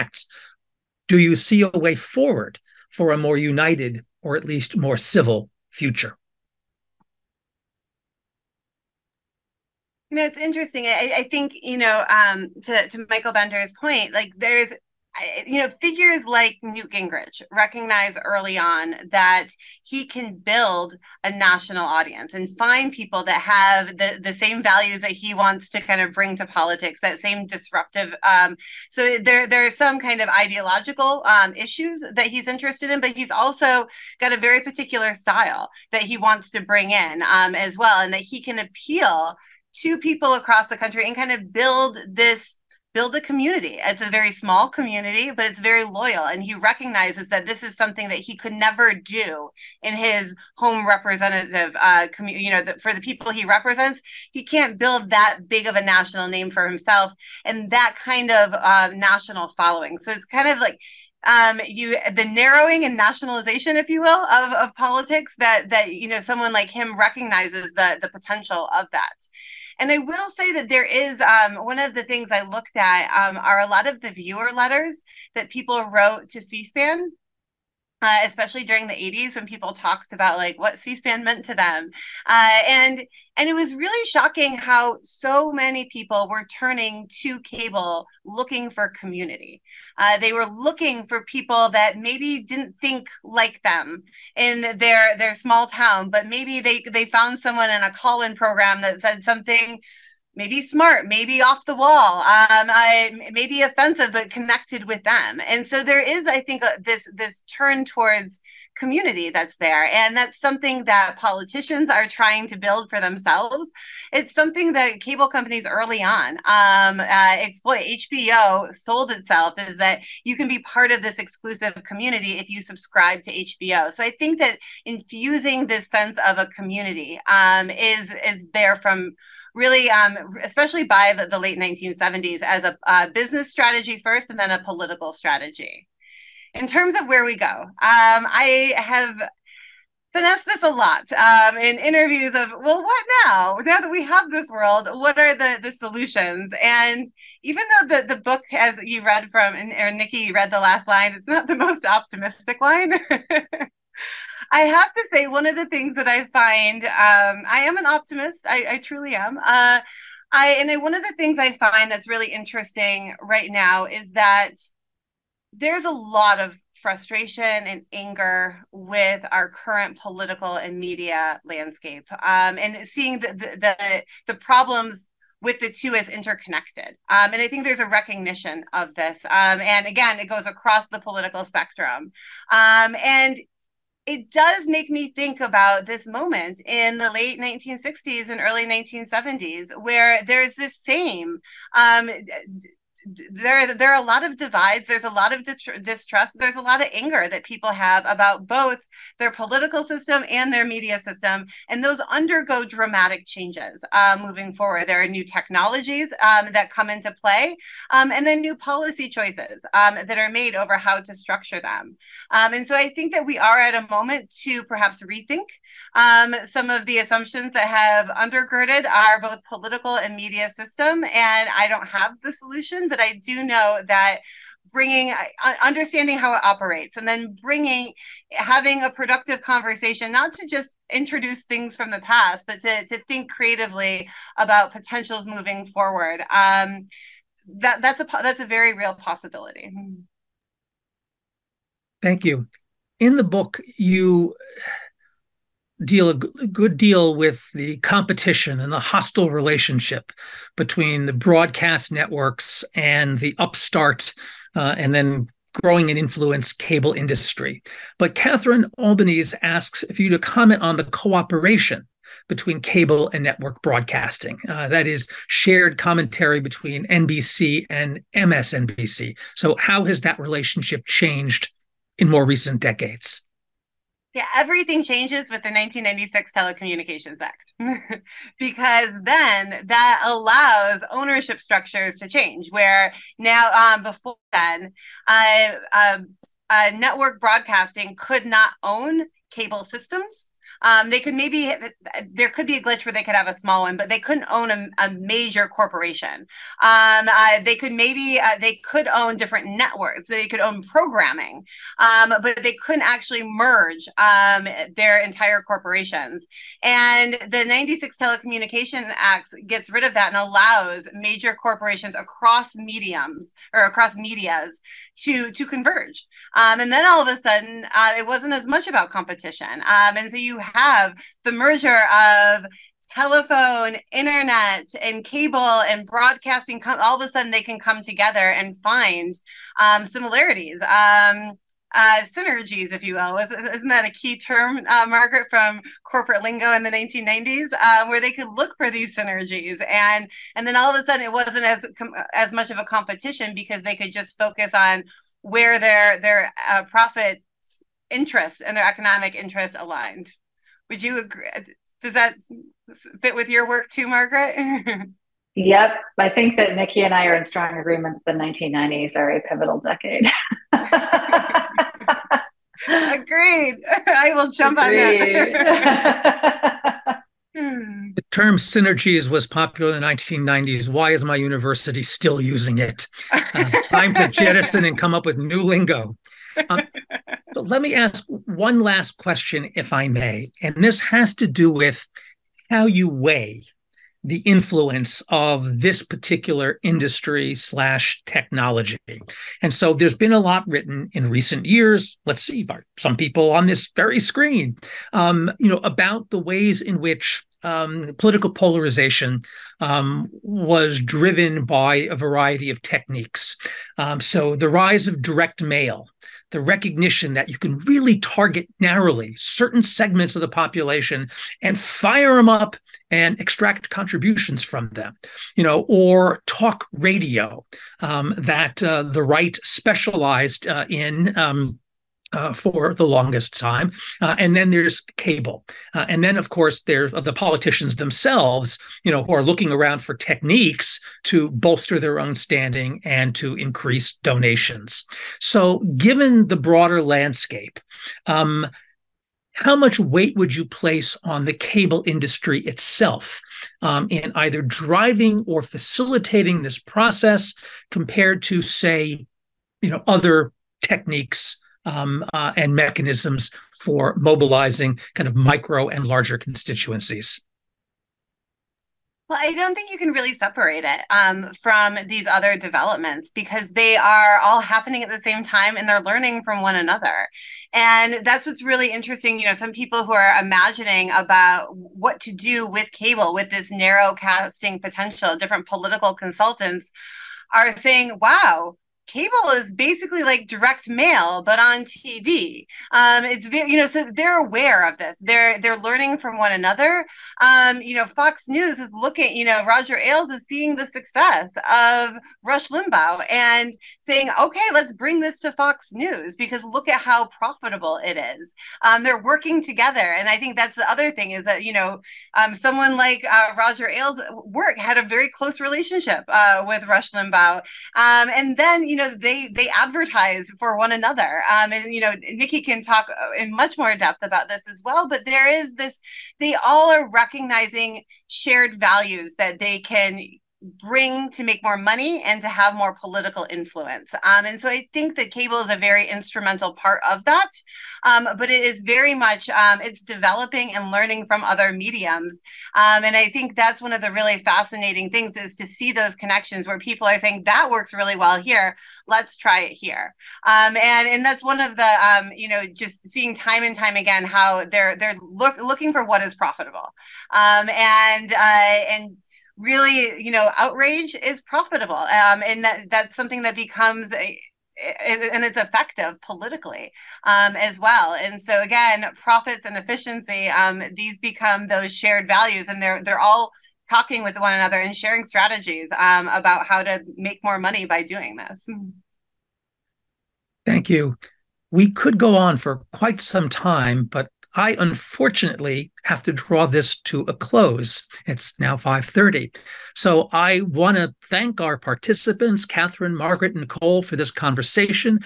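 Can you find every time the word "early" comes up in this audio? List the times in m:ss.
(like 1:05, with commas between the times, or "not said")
0:18, 1:55, 3:08.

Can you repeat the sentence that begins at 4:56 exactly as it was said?
Um, uh, they could maybe uh, they could own different networks.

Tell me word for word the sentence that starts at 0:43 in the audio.
It's a very small community, but it's very loyal.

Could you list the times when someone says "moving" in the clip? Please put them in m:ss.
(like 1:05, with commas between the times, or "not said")
3:24, 3:55.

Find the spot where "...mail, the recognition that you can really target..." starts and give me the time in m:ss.
6:45.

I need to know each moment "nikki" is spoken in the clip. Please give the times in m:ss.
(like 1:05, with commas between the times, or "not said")
2:29, 5:56, 8:32.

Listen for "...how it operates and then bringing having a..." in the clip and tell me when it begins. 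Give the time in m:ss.
3:46.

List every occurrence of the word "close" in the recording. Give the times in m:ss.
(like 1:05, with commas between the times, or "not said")
8:25, 9:37.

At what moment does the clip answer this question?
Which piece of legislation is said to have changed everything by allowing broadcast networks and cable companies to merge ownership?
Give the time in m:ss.
4:35.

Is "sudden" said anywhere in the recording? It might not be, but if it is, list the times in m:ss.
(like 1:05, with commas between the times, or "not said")
5:17, 5:27, 5:40.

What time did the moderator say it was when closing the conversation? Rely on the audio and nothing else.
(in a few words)
5:30.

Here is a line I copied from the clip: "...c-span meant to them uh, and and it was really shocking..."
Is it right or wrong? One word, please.
right.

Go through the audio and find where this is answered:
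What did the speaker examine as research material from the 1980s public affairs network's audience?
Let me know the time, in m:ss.
1:14.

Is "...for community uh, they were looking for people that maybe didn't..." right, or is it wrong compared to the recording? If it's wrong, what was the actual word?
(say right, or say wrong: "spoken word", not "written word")
right.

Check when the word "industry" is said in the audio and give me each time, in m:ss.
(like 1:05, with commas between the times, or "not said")
4:16, 6:26, 7:21.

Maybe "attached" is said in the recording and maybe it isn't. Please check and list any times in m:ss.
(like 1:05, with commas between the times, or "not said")
not said.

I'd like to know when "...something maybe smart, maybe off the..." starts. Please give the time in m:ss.
1:39.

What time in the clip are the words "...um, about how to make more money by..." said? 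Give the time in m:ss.
9:25.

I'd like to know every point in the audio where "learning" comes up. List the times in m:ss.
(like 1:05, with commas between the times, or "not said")
7:45, 8:05, 8:50.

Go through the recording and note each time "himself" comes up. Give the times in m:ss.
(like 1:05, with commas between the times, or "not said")
0:56.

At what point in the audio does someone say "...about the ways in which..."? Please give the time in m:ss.
6:35.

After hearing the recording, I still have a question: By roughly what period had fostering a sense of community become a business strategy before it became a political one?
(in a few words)
late 1970s.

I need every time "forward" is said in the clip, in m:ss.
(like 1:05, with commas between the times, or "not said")
0:01, 3:24, 3:55.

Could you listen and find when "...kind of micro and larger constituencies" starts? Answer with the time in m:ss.
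7:34.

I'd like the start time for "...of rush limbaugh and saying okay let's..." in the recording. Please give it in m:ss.
8:11.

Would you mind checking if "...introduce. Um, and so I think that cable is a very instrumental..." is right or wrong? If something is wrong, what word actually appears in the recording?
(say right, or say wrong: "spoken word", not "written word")
wrong: "influence", not "introduce".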